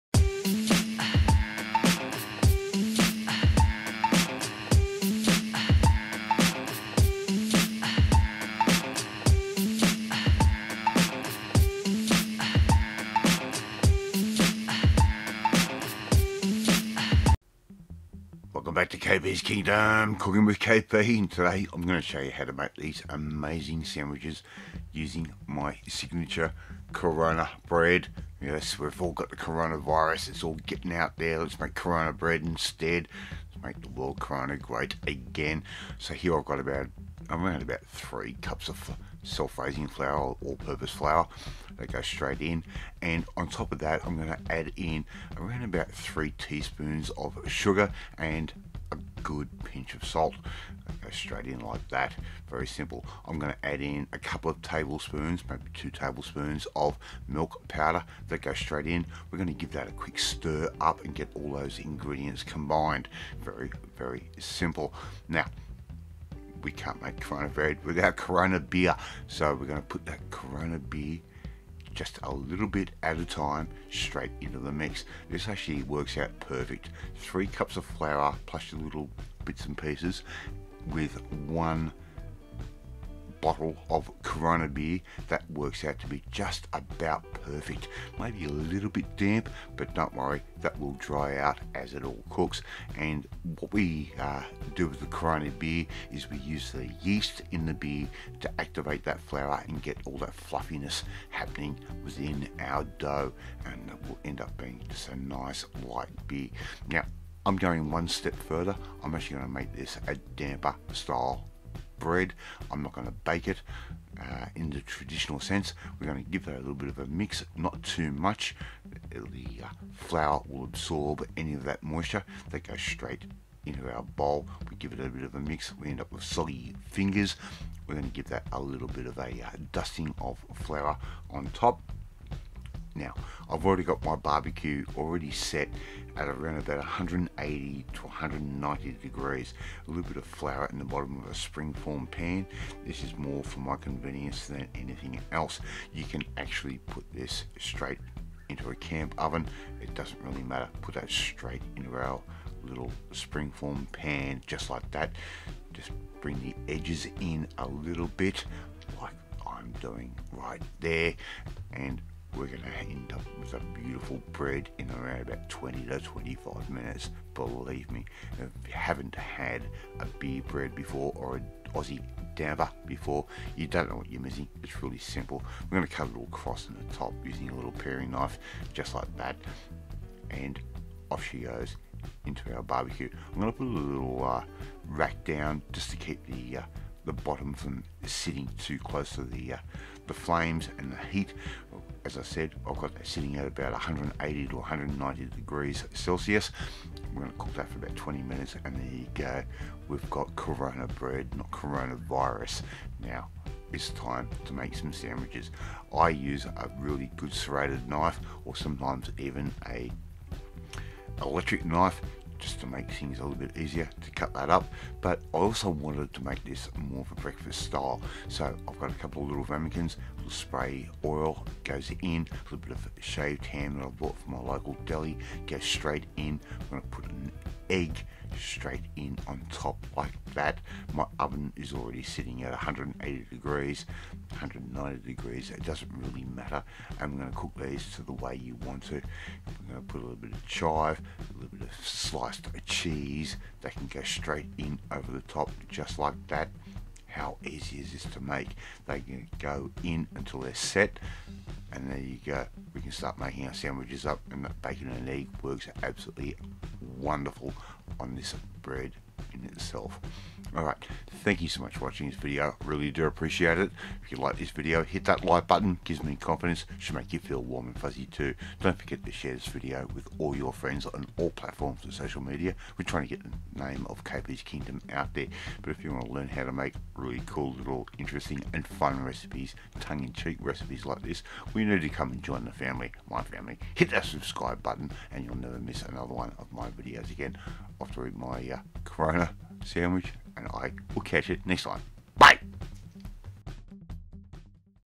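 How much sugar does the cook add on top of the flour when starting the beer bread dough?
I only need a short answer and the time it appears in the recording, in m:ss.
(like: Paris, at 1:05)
3 teaspoons, at 0:45.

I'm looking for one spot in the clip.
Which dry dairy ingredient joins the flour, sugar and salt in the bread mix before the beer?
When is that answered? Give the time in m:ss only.
0:57.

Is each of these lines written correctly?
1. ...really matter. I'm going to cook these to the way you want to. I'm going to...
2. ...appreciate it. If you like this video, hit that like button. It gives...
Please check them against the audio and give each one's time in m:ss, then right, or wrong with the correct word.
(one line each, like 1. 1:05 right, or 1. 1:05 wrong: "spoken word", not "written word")
1. 3:55 right
2. 4:23 right.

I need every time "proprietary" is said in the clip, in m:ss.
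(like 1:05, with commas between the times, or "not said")
not said.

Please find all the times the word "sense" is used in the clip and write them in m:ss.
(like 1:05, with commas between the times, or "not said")
1:55.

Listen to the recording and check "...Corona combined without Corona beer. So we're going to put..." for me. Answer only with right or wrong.
wrong.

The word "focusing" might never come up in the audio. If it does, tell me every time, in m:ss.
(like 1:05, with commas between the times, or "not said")
not said.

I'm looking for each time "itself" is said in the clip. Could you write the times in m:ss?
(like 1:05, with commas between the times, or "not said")
4:19.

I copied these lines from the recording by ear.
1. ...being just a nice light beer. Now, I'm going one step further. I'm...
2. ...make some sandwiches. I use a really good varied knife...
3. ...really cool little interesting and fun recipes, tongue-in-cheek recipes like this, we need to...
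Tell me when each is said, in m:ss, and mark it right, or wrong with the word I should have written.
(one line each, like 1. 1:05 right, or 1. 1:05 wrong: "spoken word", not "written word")
1. 1:44 right
2. 3:24 wrong: "serrated", not "varied"
3. 4:36 right.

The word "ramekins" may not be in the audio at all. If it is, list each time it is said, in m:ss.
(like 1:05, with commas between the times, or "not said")
3:39.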